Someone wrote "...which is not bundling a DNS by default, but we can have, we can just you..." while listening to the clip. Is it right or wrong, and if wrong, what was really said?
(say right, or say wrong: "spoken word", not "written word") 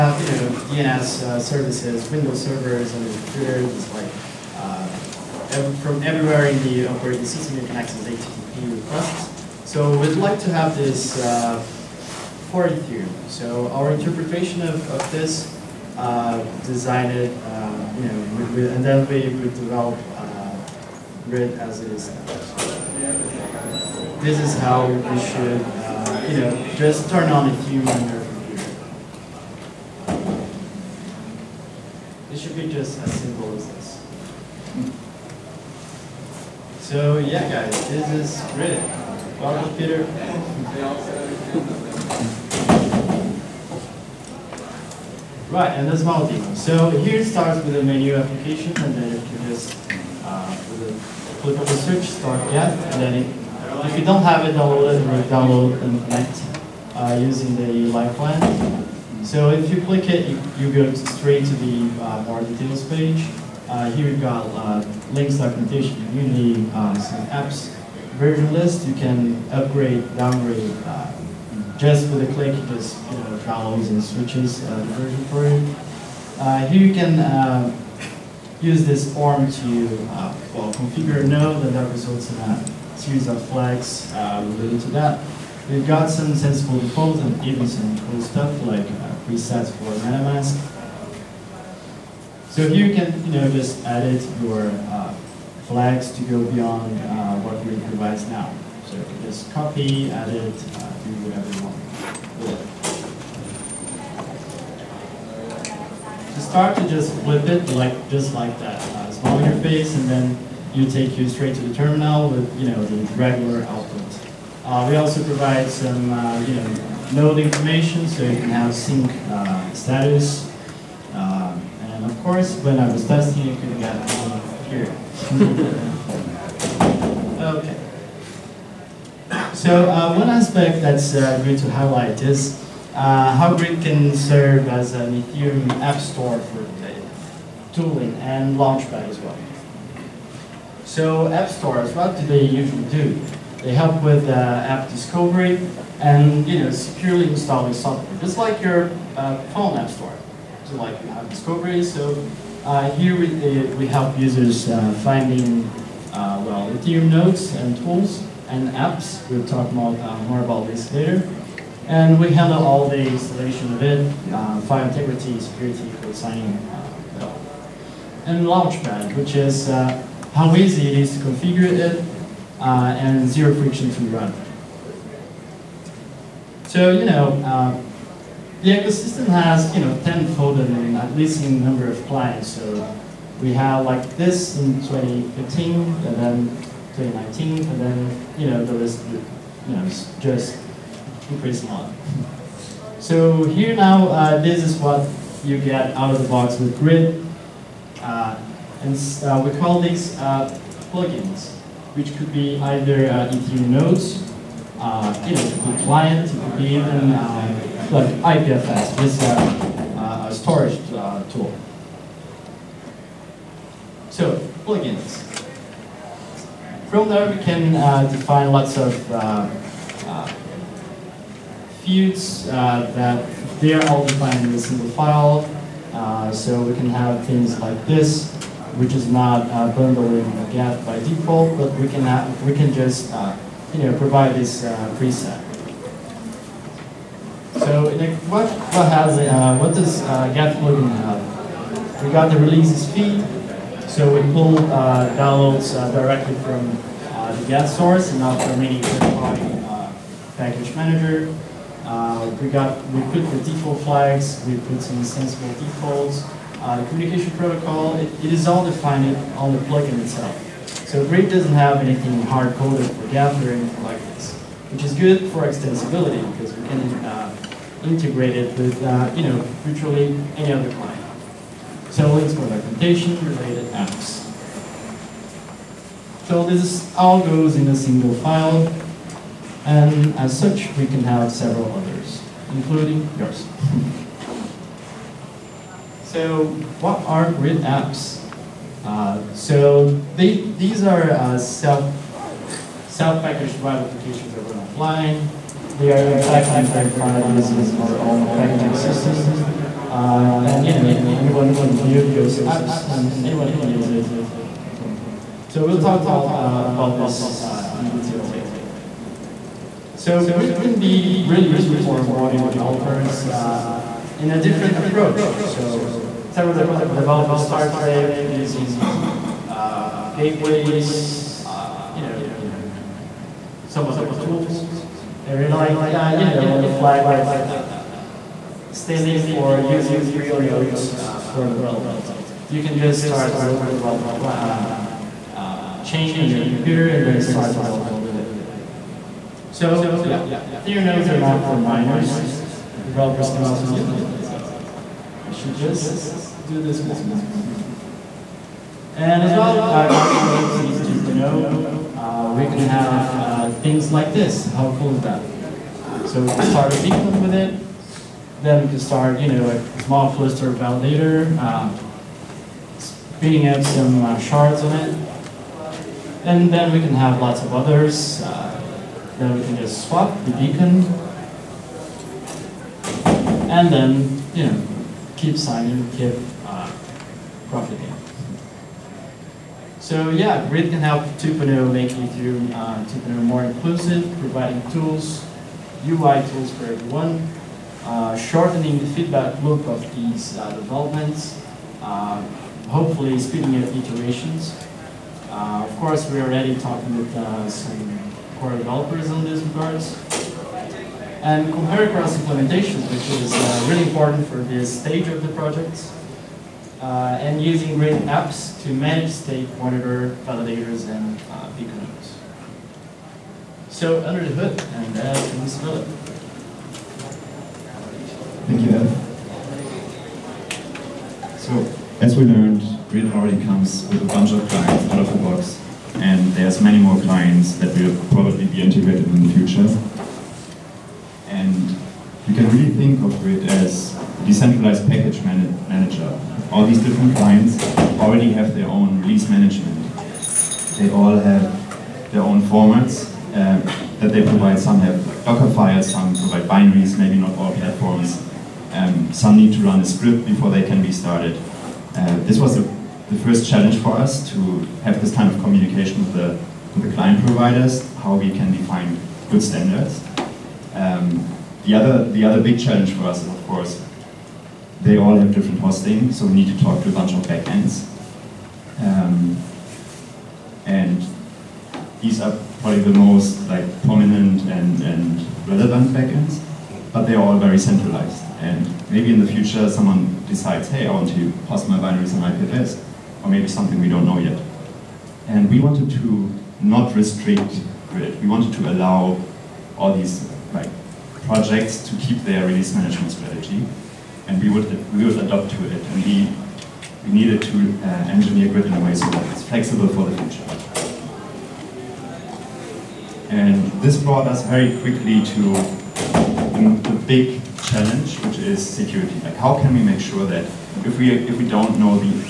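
wrong: "Geth", not "DNS".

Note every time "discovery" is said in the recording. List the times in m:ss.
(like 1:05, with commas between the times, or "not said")
2:24, 2:31.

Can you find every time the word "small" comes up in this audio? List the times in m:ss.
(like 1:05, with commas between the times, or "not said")
1:49, 5:59.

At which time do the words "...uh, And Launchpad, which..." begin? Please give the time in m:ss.
2:46.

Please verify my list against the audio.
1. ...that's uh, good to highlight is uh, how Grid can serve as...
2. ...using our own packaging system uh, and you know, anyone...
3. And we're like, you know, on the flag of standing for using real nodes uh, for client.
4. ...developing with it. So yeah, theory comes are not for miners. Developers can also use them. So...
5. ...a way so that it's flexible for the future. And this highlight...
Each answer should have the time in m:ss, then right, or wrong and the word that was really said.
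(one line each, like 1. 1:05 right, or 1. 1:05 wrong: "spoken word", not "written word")
1. 2:10 right
2. 4:57 right
3. 5:25 wrong: "development", not "client"
4. 5:37 wrong: "nodes", not "comes"
5. 8:18 wrong: "brought", not "highlight".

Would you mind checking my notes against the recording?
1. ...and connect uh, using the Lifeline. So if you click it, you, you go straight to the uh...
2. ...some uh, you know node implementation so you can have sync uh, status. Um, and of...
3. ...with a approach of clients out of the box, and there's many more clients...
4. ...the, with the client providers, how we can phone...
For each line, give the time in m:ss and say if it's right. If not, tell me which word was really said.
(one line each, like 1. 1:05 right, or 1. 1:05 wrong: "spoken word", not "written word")
1. 0:55 right
2. 1:55 wrong: "information", not "implementation"
3. 7:03 wrong: "bunch", not "approach"
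4. 7:36 wrong: "define", not "phone".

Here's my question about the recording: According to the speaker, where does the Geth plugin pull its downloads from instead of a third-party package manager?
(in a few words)
the Geth source.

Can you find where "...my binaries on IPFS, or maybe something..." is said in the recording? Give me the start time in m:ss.
8:01.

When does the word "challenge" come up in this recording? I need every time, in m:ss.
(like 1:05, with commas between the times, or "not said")
7:33, 7:42, 8:27.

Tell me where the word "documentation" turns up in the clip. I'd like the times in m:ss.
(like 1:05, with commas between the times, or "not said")
1:05, 4:32.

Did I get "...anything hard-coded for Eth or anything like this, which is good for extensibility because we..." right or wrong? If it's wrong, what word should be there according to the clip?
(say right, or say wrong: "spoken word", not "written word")
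wrong: "Geth", not "Eth".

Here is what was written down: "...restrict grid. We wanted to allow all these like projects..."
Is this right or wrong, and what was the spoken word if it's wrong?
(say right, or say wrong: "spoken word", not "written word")
right.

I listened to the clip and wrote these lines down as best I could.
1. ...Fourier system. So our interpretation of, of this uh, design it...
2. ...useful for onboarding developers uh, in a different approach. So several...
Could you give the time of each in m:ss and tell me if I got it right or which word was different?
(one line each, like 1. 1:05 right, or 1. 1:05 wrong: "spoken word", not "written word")
1. 0:12 wrong: "theorem", not "system"
2. 5:11 right.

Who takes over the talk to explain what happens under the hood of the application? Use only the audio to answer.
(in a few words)
Philipp.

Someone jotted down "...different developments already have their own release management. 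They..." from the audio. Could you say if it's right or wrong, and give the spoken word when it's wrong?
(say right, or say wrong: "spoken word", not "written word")
wrong: "clients", not "developments".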